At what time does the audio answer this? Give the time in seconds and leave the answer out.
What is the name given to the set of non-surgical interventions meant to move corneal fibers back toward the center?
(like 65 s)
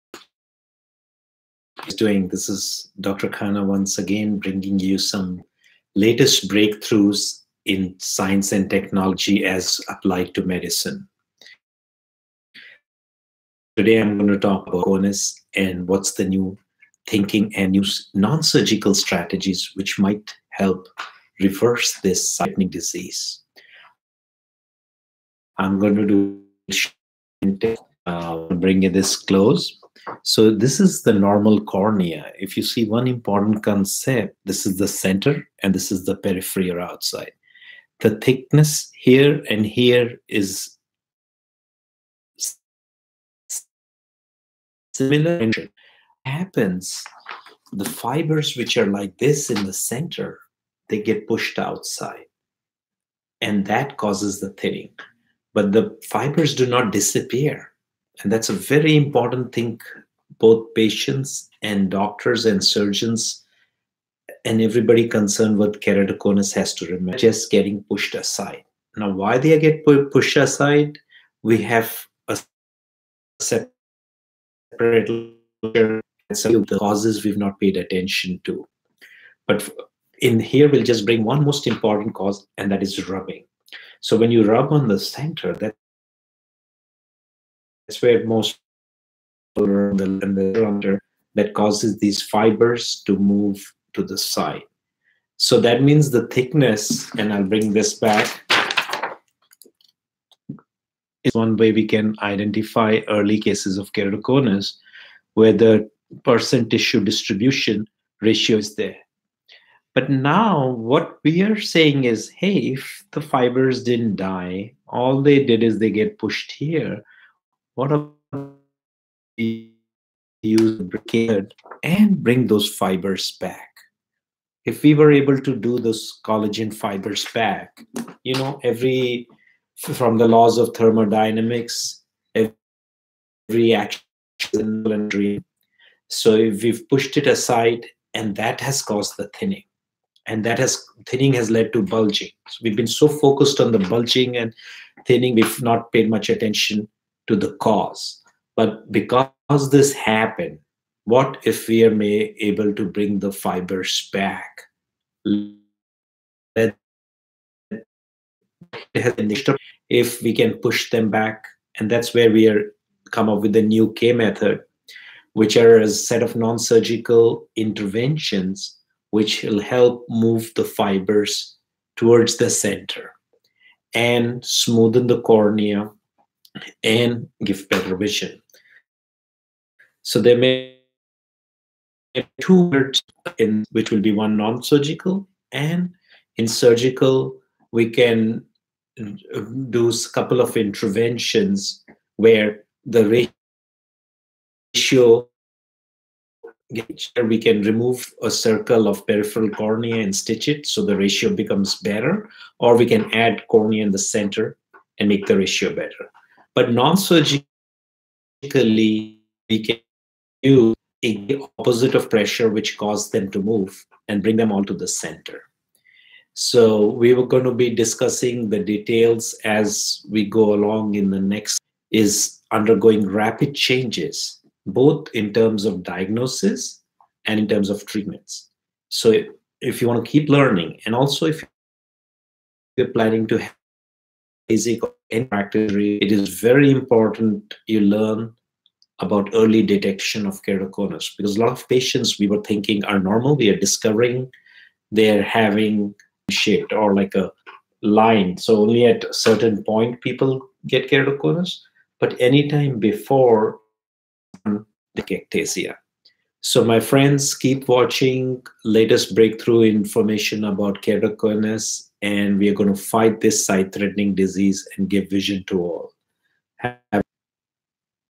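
163 s.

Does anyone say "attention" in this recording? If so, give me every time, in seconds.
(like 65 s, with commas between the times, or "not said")
77 s, 146 s.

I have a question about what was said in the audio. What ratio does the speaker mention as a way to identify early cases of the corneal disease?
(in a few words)
Percent tissue distribution ratio.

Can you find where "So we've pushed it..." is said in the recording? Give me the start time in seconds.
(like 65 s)
136 s.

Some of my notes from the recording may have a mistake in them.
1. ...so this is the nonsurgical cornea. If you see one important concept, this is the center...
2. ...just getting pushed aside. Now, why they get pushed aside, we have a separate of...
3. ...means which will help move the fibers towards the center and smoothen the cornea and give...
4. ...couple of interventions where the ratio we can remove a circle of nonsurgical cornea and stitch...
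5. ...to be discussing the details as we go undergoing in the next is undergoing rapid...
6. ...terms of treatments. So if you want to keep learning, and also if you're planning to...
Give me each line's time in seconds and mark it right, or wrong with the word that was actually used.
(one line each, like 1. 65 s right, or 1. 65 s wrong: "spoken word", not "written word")
1. 30 s wrong: "normal", not "nonsurgical"
2. 67 s right
3. 167 s wrong: "interventions", not "means"
4. 190 s wrong: "peripheral", not "nonsurgical"
5. 217 s wrong: "along", not "undergoing"
6. 227 s right.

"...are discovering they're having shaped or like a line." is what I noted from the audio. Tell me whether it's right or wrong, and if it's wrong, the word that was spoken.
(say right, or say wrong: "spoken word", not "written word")
right.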